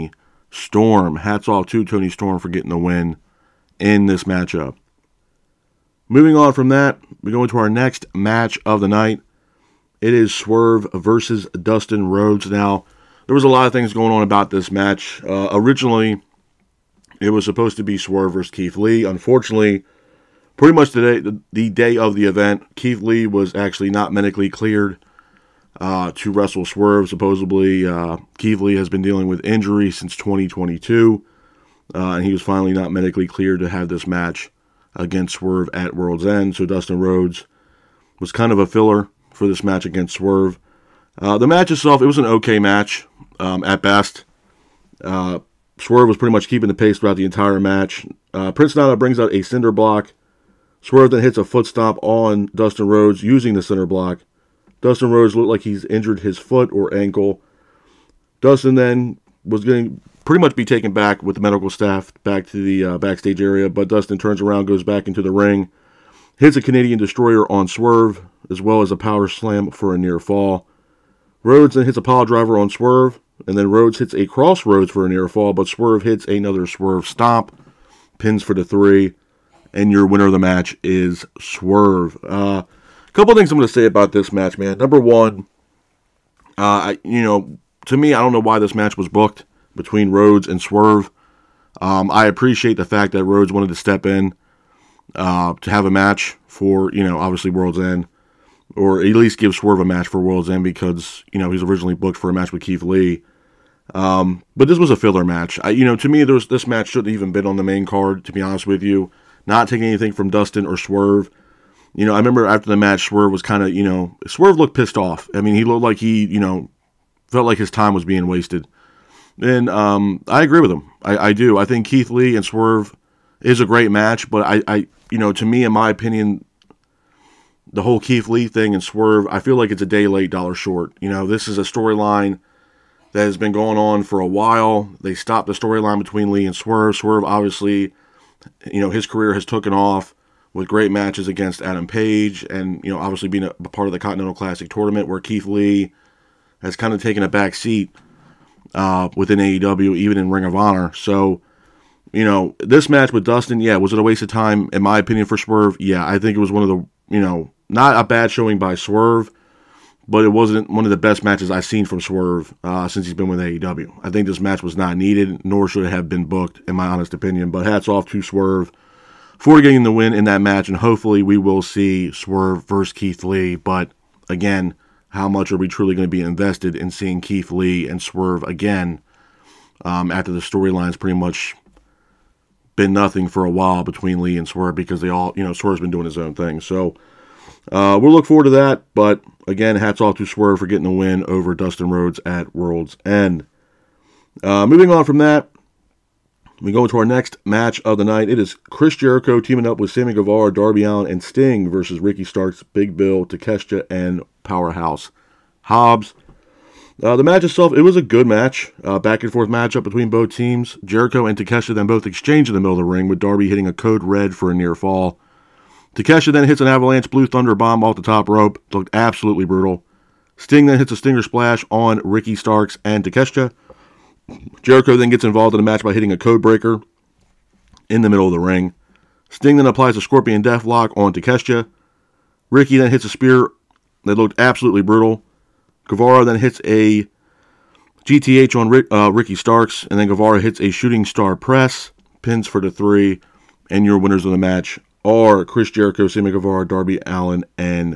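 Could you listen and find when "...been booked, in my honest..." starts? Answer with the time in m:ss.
2:46.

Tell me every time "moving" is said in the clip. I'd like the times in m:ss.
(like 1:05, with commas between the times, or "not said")
0:06, 3:14.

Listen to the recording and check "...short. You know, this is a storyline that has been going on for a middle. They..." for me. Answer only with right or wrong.
wrong.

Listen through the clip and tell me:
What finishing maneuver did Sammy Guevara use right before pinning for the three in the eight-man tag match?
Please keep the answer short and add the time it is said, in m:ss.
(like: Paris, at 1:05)
Shooting star press, at 4:00.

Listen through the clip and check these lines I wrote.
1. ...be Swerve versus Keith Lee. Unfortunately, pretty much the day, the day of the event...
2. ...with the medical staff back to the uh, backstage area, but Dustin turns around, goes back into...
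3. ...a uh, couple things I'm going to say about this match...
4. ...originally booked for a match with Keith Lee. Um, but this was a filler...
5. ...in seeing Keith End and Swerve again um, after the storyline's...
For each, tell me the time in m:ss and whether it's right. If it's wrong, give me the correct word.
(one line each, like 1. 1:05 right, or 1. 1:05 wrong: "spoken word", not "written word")
1. 0:17 right
2. 1:01 right
3. 1:22 right
4. 1:41 right
5. 2:56 wrong: "Lee", not "End".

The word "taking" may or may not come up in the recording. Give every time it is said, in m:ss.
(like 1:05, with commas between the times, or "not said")
1:49.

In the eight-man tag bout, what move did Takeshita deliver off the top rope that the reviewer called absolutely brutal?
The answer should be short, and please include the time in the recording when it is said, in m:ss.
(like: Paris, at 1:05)
Avalanche blue thunder bomb, at 3:36.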